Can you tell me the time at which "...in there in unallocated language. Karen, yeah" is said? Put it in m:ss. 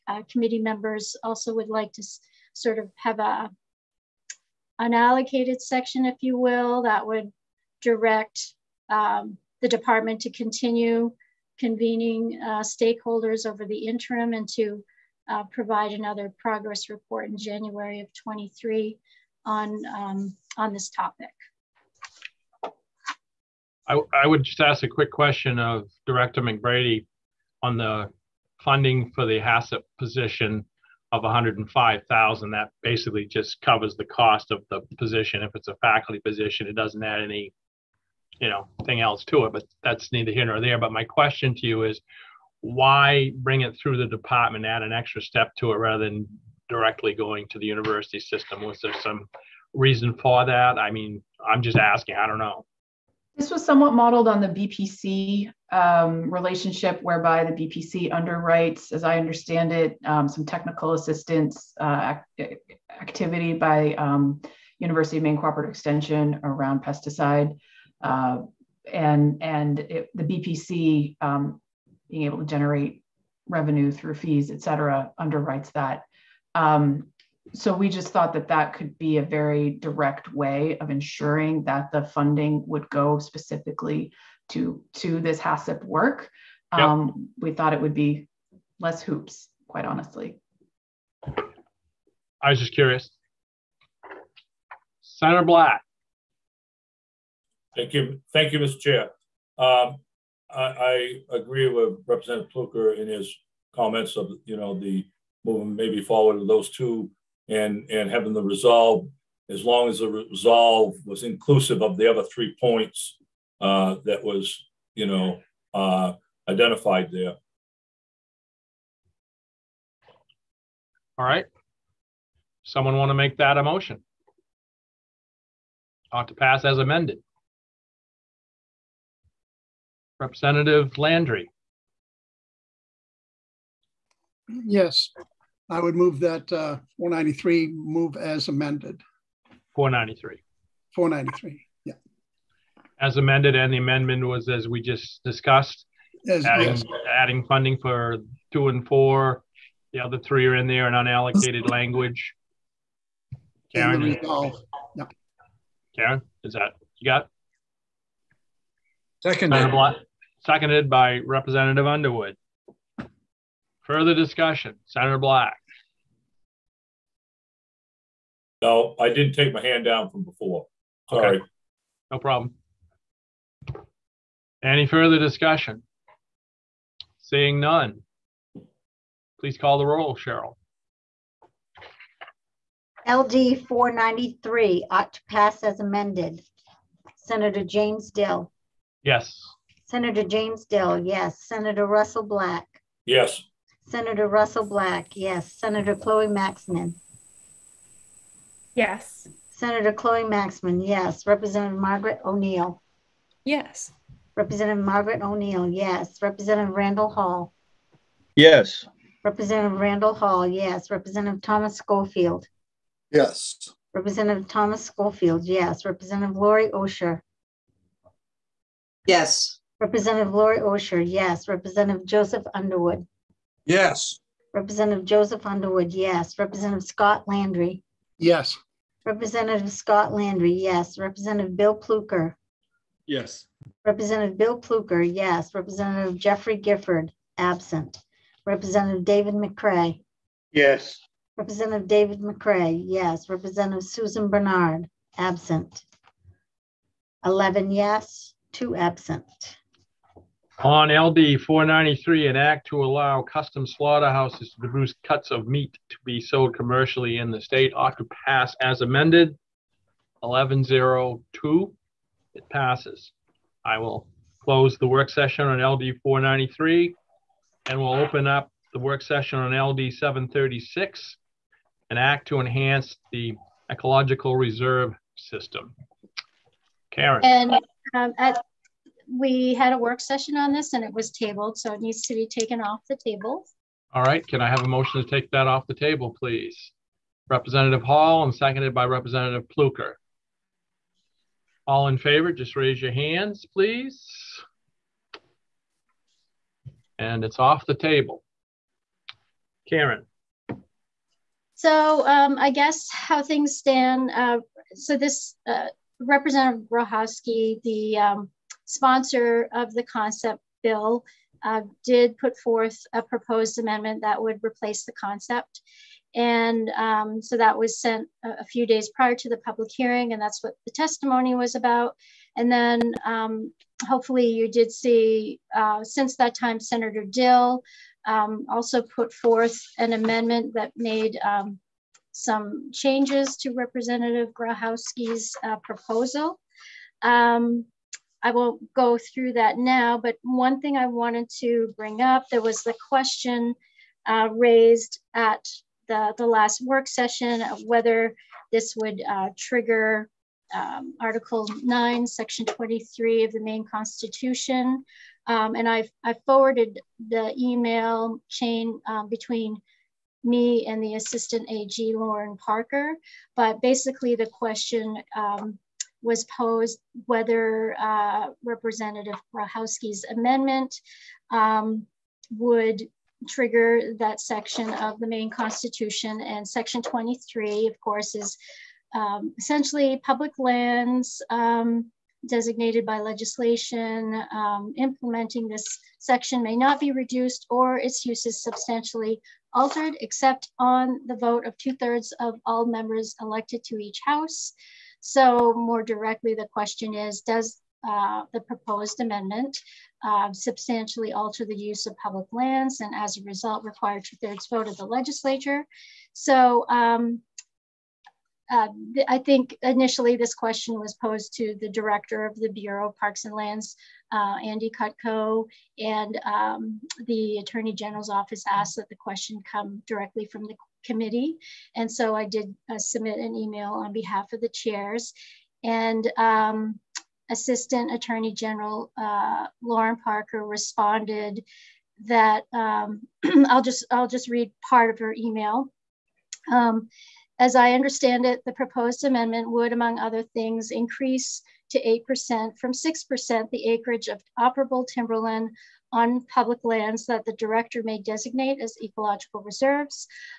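2:30.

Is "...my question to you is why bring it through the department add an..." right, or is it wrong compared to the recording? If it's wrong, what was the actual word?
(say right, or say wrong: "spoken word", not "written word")
right.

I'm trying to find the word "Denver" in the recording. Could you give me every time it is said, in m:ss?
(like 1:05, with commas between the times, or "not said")
not said.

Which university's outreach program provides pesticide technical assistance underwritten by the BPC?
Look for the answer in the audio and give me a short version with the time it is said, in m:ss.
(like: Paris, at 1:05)
University of Maine Cooperative Extension, at 1:04.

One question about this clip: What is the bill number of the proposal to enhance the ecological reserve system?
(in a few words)
LD 736.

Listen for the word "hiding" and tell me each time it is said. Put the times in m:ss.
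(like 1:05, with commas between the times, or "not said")
not said.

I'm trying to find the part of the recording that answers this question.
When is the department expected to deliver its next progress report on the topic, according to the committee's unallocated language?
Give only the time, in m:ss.
0:17.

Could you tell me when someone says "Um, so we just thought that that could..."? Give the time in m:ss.
1:16.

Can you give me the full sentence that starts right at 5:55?
Um, and I've, I forwarded the email chain um, between me and the assistant AG, Lauren Parker.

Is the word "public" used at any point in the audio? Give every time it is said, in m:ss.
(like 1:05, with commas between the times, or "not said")
5:19, 6:20, 6:42, 7:26.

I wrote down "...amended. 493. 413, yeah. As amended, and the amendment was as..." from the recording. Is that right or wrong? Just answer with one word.
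wrong.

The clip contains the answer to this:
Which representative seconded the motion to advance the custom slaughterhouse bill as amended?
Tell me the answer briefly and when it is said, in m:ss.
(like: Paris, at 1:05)
Representative Underwood, at 2:41.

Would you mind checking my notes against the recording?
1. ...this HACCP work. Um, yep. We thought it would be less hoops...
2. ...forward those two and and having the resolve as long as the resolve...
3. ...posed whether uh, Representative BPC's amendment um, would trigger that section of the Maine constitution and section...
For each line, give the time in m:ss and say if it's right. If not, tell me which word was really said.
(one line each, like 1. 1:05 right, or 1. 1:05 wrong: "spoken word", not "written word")
1. 1:25 right
2. 1:46 right
3. 6:06 wrong: "Grohoski", not "BPC".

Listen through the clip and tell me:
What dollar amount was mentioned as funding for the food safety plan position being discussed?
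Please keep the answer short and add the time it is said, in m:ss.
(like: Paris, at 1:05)
105,000, at 0:31.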